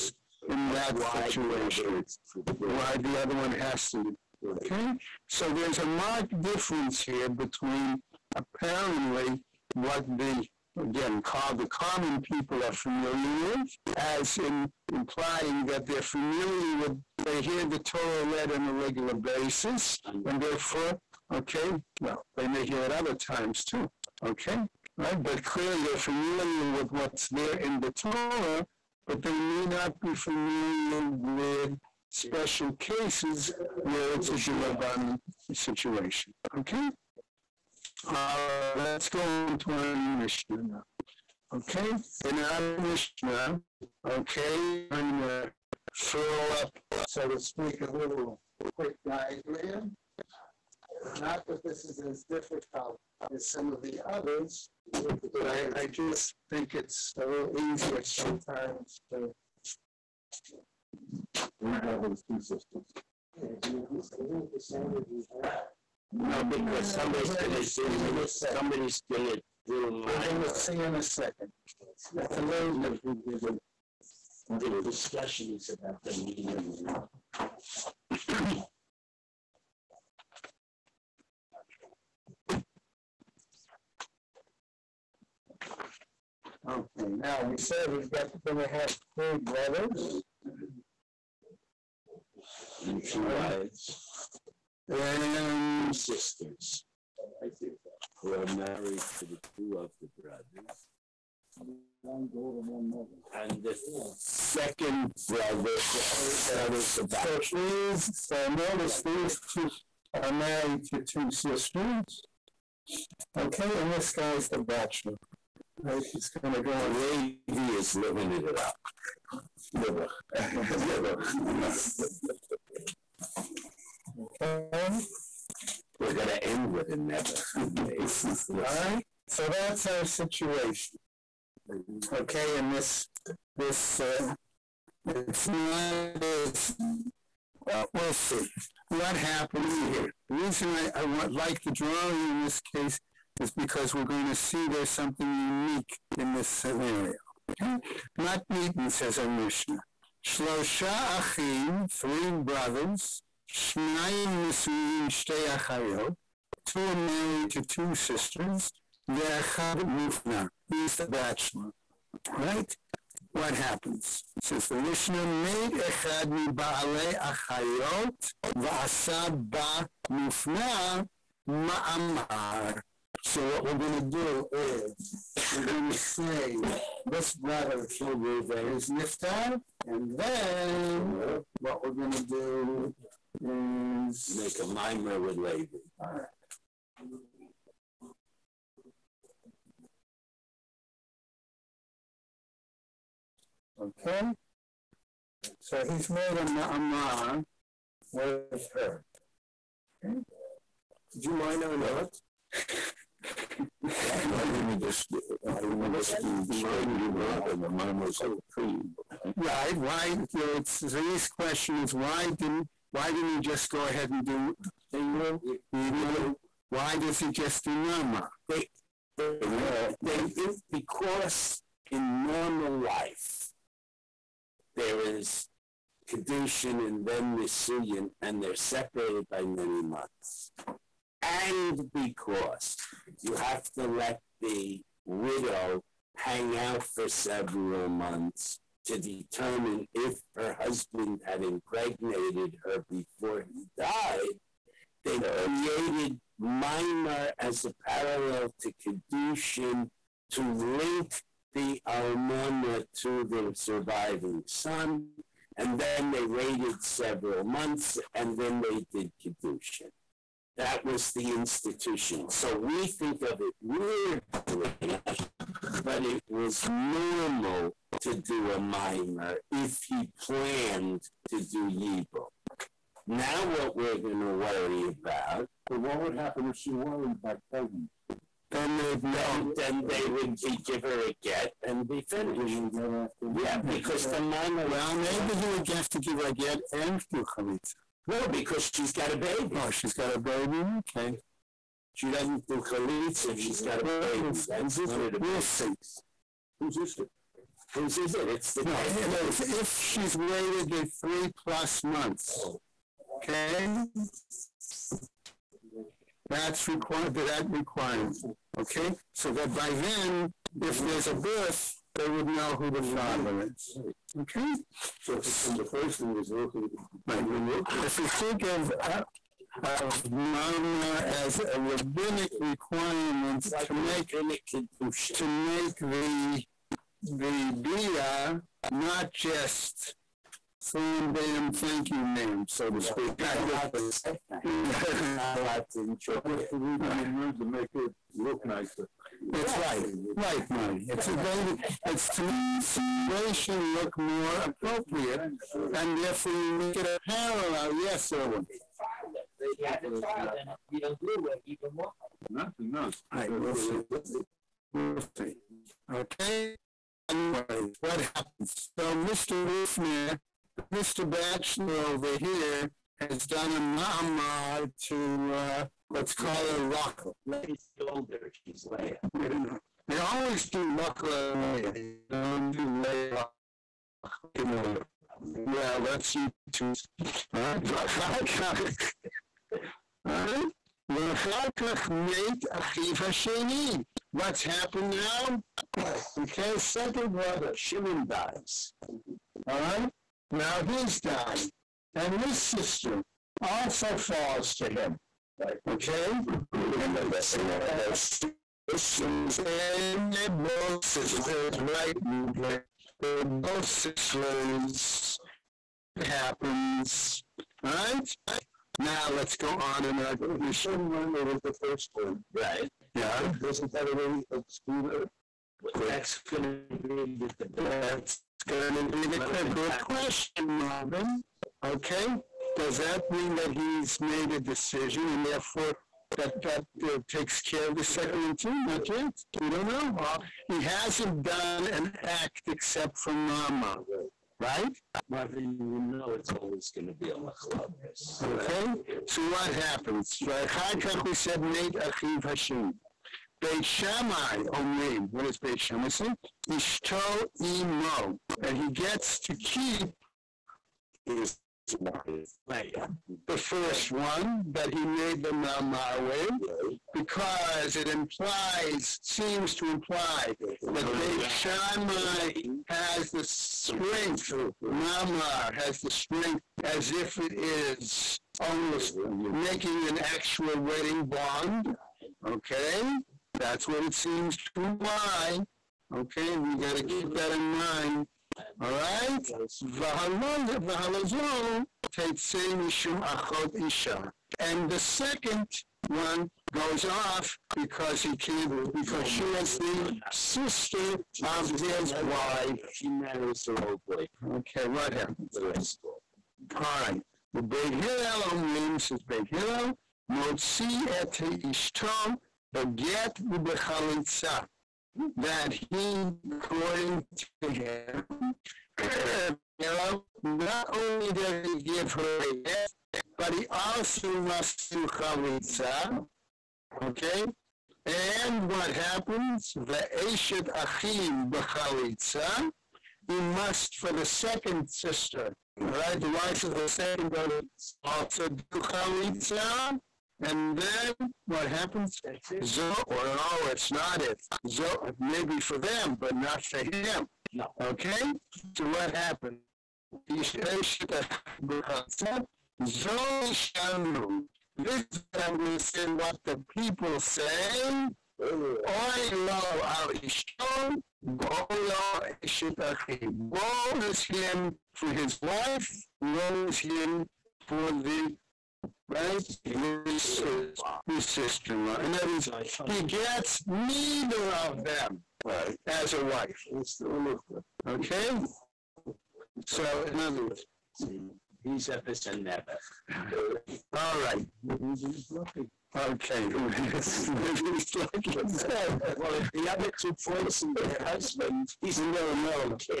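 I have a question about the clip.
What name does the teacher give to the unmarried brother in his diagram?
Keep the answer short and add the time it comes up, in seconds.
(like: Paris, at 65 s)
Levi, at 116 s.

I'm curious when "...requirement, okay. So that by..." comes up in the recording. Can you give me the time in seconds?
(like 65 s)
307 s.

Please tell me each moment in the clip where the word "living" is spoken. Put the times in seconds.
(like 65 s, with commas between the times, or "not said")
117 s.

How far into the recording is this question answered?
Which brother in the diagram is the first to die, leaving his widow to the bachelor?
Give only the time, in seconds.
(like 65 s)
177 s.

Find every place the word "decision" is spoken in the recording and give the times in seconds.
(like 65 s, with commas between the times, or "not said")
424 s.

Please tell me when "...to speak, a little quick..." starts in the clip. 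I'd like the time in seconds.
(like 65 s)
47 s.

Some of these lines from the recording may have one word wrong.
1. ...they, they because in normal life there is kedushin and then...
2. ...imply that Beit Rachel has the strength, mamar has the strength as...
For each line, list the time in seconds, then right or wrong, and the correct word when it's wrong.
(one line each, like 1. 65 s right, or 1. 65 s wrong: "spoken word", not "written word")
1. 219 s right
2. 459 s wrong: "Shammai", not "Rachel".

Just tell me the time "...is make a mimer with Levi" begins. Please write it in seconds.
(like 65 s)
183 s.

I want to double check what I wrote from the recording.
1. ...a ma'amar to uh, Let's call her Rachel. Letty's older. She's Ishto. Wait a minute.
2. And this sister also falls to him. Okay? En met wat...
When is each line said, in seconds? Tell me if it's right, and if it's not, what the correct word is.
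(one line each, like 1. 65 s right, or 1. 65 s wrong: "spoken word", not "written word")
1. 363 s wrong: "Leah", not "Ishto"
2. 391 s right.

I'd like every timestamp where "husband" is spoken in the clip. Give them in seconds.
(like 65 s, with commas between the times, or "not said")
240 s, 580 s.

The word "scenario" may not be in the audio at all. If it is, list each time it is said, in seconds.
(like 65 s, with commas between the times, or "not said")
146 s.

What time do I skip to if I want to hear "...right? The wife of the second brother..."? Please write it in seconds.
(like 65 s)
525 s.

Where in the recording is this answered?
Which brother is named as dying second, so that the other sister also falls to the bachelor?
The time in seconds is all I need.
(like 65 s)
387 s.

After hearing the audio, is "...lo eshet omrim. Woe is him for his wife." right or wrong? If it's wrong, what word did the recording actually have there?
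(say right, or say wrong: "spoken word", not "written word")
wrong: "achim", not "omrim".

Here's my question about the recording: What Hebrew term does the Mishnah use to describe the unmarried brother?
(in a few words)
mufna.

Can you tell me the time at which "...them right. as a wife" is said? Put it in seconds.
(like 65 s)
564 s.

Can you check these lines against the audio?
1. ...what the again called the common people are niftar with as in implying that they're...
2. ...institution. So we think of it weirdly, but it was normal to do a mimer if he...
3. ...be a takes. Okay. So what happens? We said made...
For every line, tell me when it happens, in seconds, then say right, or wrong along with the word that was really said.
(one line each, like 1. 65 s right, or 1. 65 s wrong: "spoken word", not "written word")
1. 9 s wrong: "familiar", not "niftar"
2. 261 s right
3. 437 s wrong: "machlokes", not "takes".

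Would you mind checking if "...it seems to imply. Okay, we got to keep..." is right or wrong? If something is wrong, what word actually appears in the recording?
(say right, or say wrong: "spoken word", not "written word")
right.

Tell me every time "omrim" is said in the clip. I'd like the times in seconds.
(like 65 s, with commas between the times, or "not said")
444 s, 498 s.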